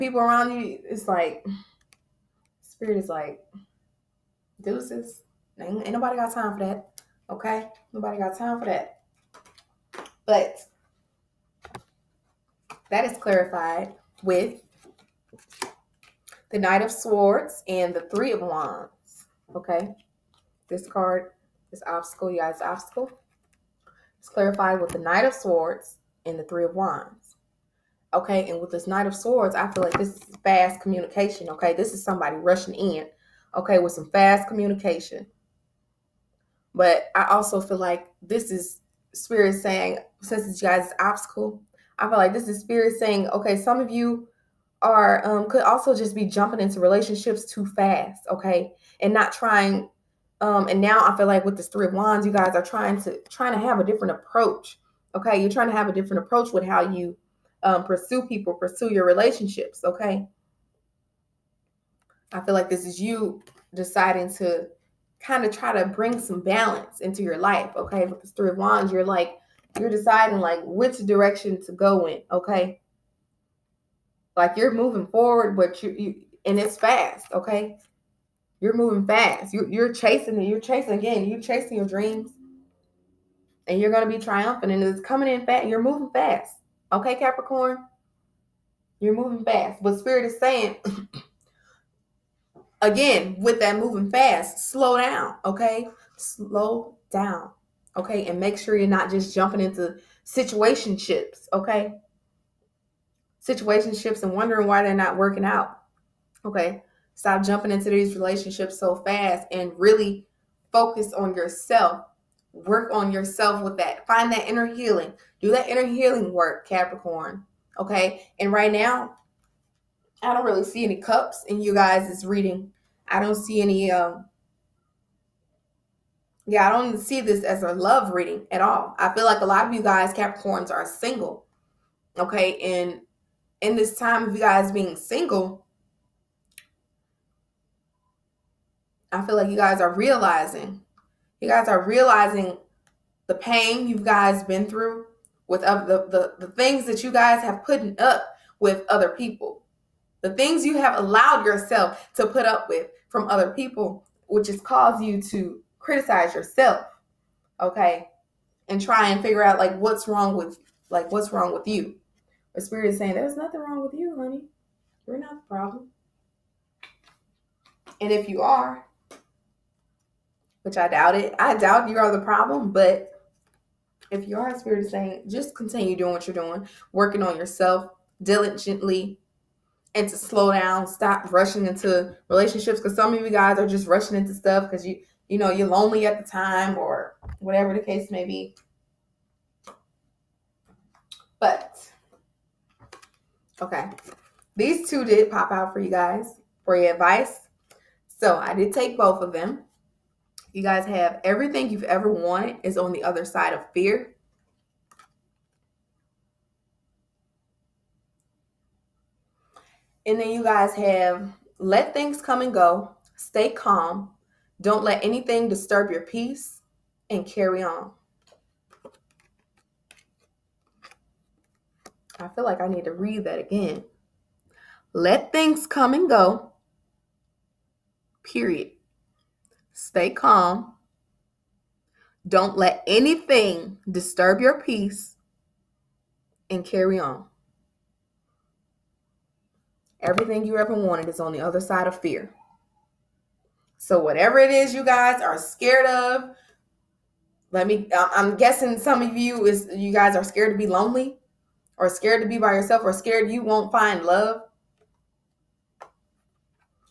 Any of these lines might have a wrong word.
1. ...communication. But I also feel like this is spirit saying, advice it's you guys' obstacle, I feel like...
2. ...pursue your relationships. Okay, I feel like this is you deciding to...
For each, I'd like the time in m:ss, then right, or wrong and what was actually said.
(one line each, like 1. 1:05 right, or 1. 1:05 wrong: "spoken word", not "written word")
1. 0:34 wrong: "since", not "advice"
2. 0:58 right.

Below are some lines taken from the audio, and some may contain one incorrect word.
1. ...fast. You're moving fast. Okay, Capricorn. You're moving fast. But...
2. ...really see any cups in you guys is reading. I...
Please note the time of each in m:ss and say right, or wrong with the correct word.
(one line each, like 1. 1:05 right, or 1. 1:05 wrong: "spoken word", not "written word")
1. 1:25 right
2. 2:00 right.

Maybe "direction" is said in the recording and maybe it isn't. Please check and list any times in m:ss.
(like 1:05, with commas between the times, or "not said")
1:10.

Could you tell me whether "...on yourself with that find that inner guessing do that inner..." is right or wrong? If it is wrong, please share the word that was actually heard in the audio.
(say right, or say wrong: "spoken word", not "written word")
wrong: "healing", not "guessing".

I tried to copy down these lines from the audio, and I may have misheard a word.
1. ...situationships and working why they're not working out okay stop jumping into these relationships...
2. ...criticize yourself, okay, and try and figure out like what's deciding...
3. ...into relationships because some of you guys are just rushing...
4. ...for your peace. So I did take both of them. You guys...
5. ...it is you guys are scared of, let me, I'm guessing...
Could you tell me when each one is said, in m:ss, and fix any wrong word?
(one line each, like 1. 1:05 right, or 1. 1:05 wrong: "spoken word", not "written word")
1. 1:43 wrong: "wondering", not "working"
2. 2:35 wrong: "wrong", not "deciding"
3. 3:01 right
4. 3:16 wrong: "advice", not "peace"
5. 4:04 right.